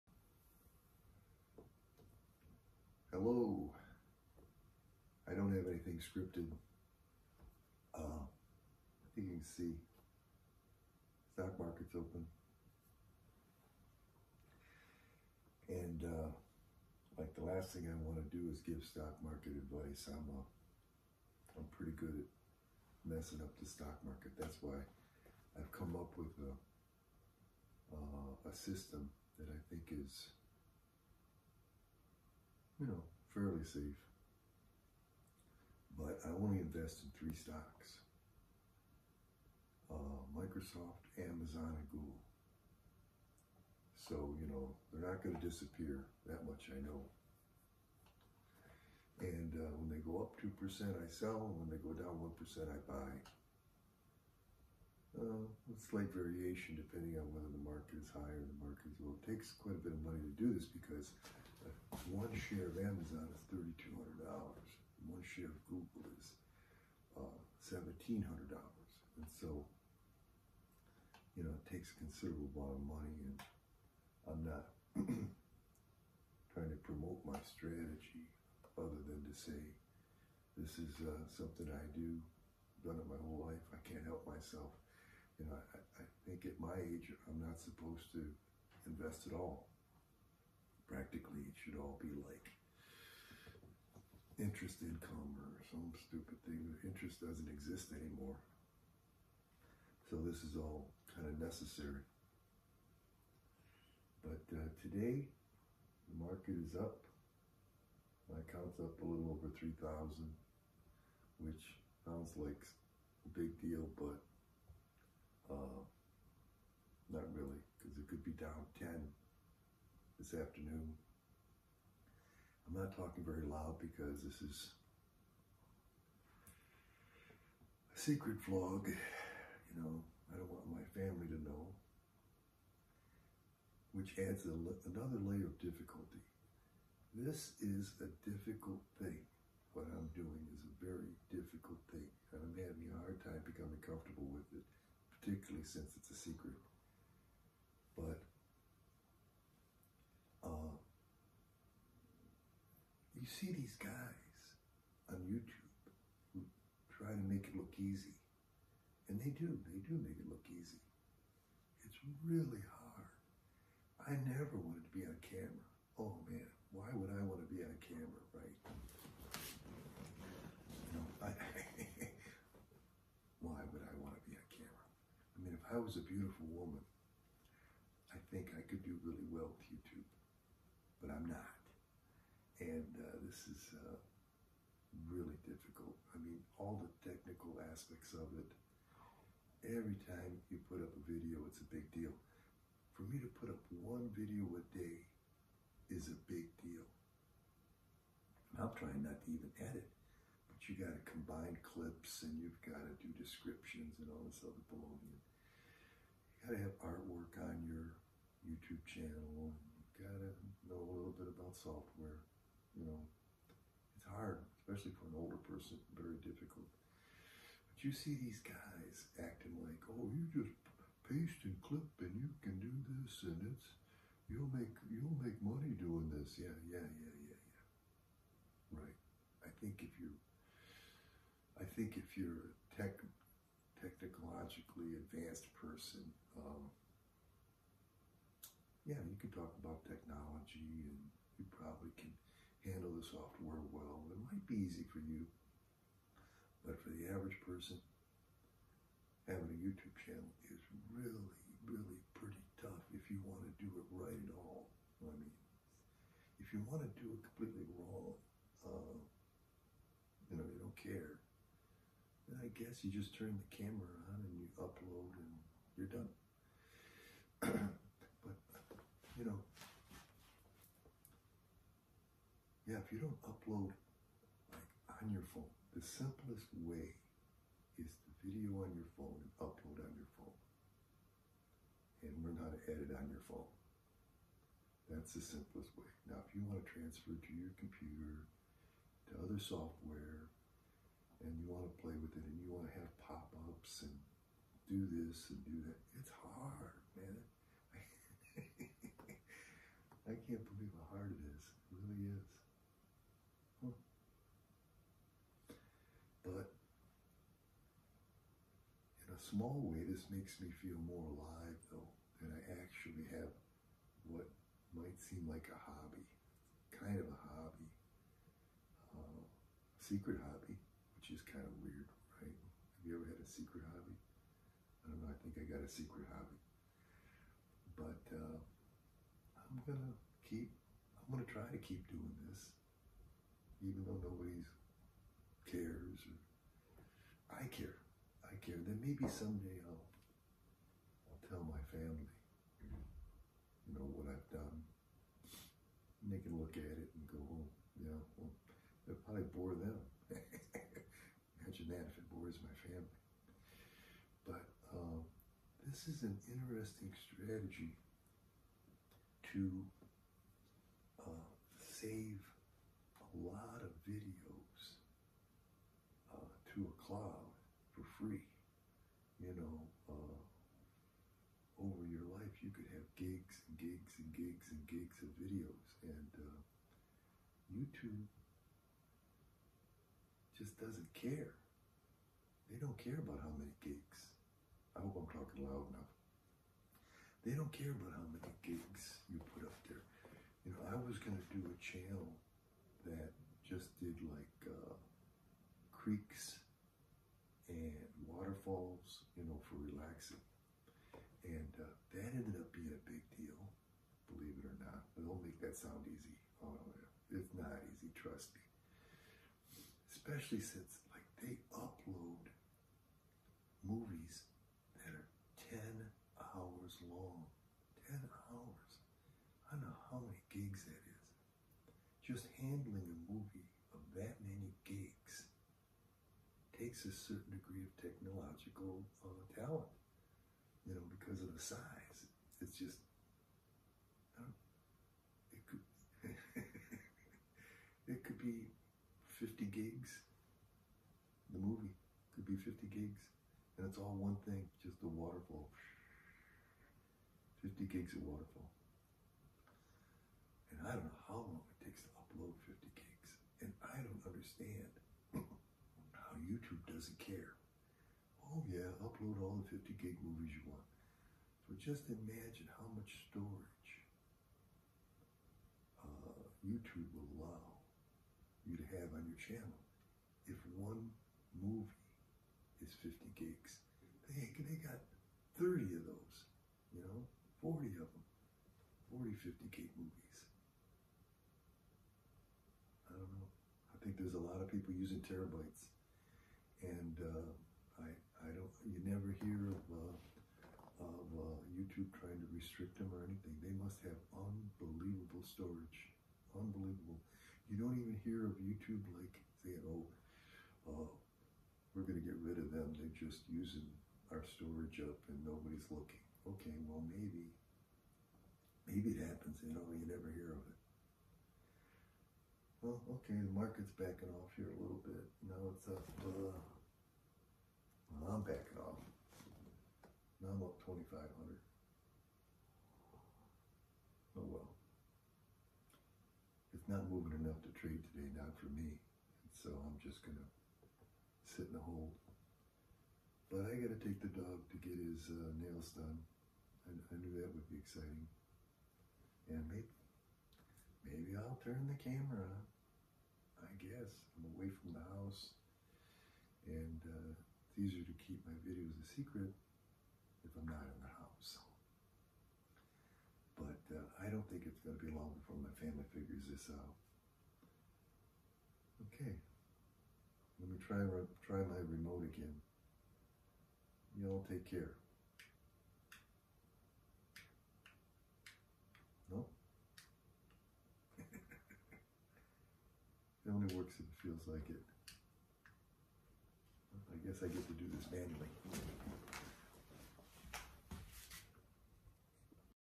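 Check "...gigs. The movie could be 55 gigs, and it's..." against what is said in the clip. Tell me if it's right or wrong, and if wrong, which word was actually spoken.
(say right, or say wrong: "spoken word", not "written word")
wrong: "50", not "55".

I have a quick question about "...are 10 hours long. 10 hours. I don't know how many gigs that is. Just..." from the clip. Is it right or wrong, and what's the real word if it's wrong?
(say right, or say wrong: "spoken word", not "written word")
right.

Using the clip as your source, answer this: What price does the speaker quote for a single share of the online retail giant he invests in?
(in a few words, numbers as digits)
$3,200.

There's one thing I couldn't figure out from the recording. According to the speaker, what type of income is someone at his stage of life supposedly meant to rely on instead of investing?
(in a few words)
interest income.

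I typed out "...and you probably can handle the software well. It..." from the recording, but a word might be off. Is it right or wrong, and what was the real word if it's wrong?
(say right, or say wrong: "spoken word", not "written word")
right.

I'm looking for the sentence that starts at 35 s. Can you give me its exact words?
But I only invest in three stocks.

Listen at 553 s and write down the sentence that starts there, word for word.
But uh, I don't think it's going to be long before my family figures this out.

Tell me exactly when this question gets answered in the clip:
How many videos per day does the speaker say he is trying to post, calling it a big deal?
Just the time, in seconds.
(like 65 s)
193 s.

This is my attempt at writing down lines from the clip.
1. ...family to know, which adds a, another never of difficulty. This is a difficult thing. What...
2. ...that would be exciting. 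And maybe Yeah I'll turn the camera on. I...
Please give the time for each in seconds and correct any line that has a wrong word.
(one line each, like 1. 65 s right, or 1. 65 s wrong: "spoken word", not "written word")
1. 130 s wrong: "layer", not "never"
2. 537 s wrong: "Maybe", not "Yeah".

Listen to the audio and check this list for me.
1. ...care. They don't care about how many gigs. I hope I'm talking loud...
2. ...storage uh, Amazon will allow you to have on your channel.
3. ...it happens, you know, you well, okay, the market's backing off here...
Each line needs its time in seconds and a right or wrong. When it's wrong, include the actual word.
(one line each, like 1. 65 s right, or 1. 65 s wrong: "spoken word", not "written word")
1. 380 s right
2. 463 s wrong: "YouTube", not "Amazon"
3. 508 s right.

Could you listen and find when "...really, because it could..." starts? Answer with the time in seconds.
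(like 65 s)
117 s.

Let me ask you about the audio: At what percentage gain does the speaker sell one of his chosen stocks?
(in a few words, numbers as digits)
2%.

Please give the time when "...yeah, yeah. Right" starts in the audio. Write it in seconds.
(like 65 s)
227 s.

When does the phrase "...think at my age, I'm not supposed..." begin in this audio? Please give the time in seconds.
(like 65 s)
86 s.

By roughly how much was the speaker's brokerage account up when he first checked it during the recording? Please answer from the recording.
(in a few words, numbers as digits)
a little over 3,000.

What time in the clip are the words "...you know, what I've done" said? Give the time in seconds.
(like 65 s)
343 s.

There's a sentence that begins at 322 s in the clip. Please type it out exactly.
Have you ever had a secret hobby?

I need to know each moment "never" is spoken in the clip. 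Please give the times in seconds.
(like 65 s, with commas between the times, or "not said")
164 s, 488 s.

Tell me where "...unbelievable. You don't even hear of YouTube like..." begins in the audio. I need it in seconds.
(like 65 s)
496 s.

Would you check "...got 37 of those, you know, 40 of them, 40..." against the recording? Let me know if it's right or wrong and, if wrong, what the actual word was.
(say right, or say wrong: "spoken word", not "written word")
wrong: "30", not "37".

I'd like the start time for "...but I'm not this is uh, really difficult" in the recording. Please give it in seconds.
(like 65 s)
180 s.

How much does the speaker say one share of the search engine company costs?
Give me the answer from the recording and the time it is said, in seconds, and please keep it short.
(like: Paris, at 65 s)
$1,700, at 67 s.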